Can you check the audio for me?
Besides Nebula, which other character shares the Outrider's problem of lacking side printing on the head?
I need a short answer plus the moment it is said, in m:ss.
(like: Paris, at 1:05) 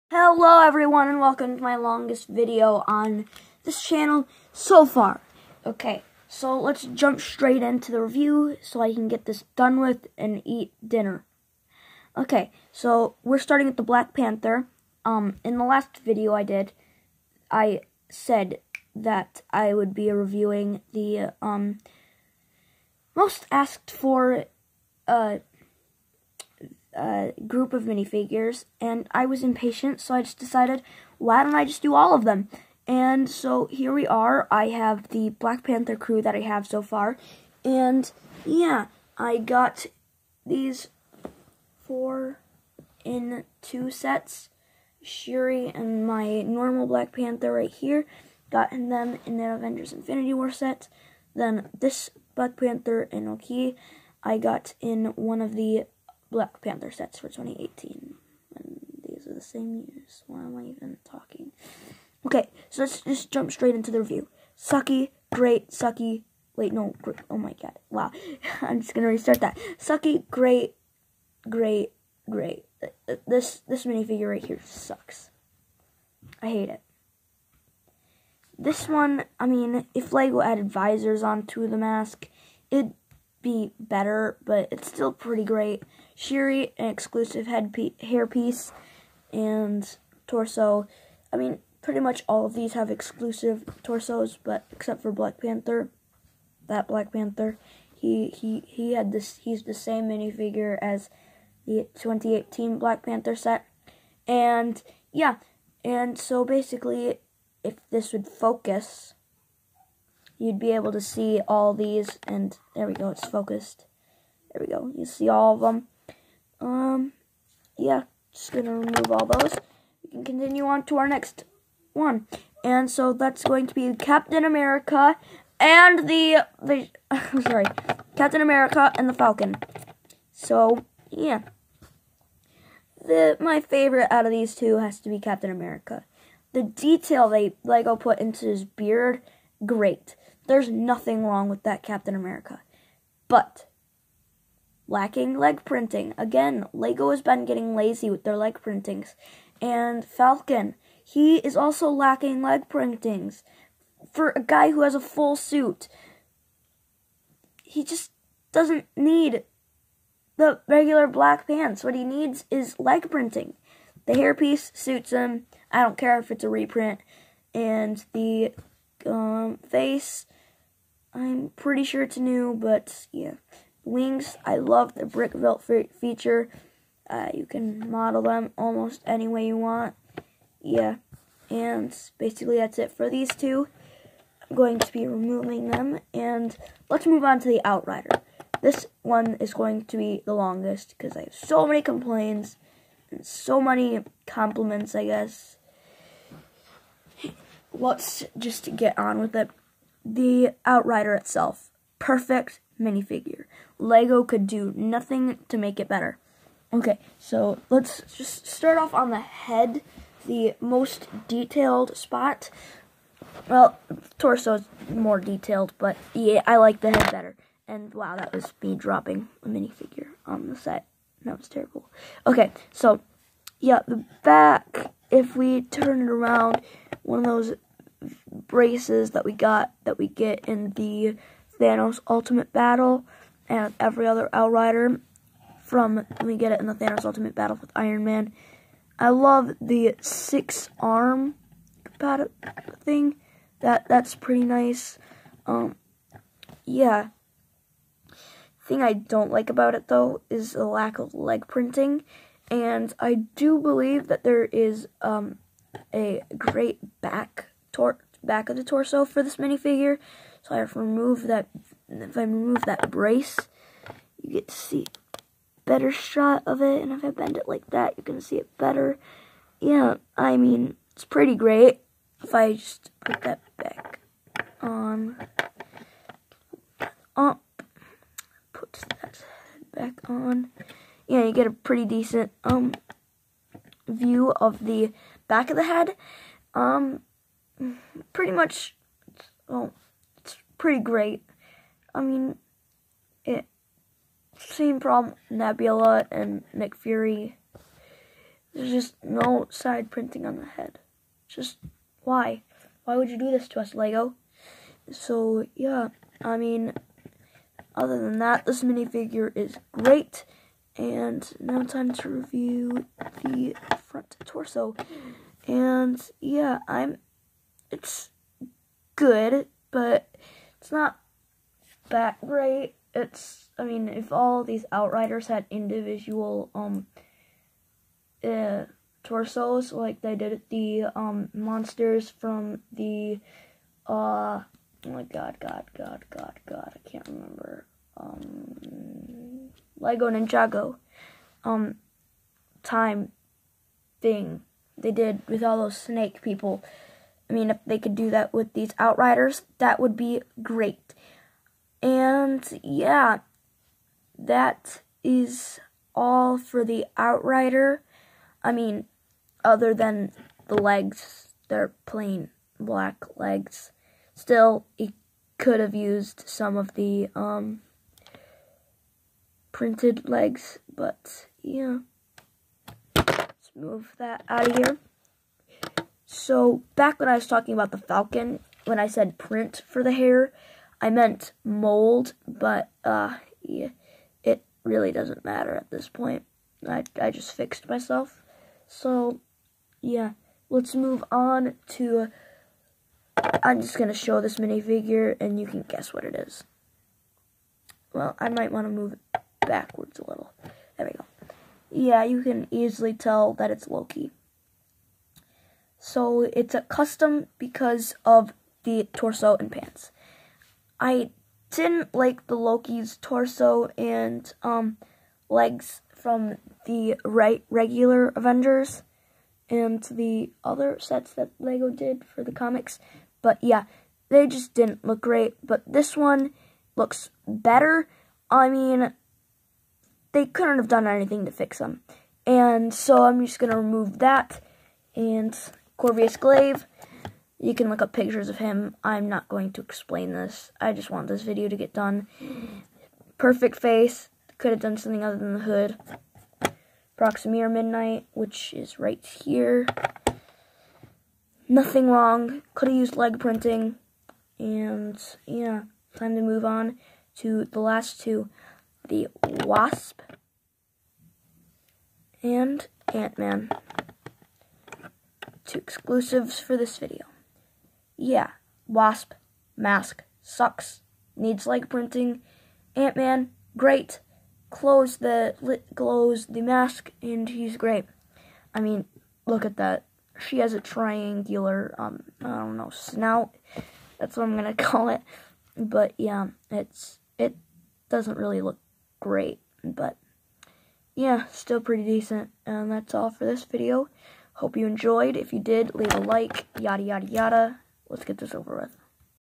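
Nick Fury, at 4:56.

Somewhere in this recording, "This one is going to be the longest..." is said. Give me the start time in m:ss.
3:08.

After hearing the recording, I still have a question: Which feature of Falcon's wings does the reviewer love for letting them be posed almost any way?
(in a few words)
brick velt feature.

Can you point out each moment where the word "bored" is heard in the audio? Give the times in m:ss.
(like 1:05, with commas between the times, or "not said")
not said.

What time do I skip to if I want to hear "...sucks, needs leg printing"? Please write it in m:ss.
7:50.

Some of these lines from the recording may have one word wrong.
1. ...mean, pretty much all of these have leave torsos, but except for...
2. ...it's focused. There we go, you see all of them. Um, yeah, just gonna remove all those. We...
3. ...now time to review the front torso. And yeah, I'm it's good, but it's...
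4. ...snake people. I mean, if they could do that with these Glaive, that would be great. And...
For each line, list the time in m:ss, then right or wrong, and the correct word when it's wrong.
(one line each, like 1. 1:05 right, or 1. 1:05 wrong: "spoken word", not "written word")
1. 1:31 wrong: "exclusive", not "leave"
2. 1:53 right
3. 5:11 right
4. 5:45 wrong: "Outriders", not "Glaive".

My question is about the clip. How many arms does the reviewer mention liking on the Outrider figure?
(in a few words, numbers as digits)
6.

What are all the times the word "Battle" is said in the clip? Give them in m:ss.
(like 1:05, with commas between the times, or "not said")
3:52, 3:57.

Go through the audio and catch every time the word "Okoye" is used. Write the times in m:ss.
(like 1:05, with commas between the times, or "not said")
0:53.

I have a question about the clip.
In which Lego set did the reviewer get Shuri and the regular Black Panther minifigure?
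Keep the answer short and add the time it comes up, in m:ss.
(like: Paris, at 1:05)
Avengers Infinity War, at 0:49.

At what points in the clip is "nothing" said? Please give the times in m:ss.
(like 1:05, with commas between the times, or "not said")
2:20, 3:24, 7:31.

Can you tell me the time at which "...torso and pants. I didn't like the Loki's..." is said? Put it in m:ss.
6:48.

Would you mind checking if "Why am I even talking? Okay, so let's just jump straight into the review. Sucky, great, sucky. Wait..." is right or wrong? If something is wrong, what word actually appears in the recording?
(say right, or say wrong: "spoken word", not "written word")
right.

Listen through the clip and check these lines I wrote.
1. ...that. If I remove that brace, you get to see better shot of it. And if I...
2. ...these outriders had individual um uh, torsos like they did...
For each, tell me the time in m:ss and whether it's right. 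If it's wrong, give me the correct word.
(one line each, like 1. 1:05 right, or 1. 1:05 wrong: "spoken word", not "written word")
1. 4:21 right
2. 5:24 right.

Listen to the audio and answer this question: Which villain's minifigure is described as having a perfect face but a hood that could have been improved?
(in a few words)
Corvus Glaive.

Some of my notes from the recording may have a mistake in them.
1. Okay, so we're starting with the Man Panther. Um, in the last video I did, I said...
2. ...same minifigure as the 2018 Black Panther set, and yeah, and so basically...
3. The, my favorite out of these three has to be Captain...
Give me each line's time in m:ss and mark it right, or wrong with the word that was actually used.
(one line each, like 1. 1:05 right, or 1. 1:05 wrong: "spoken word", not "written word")
1. 0:12 wrong: "Black", not "Man"
2. 1:39 right
3. 2:13 wrong: "two", not "three".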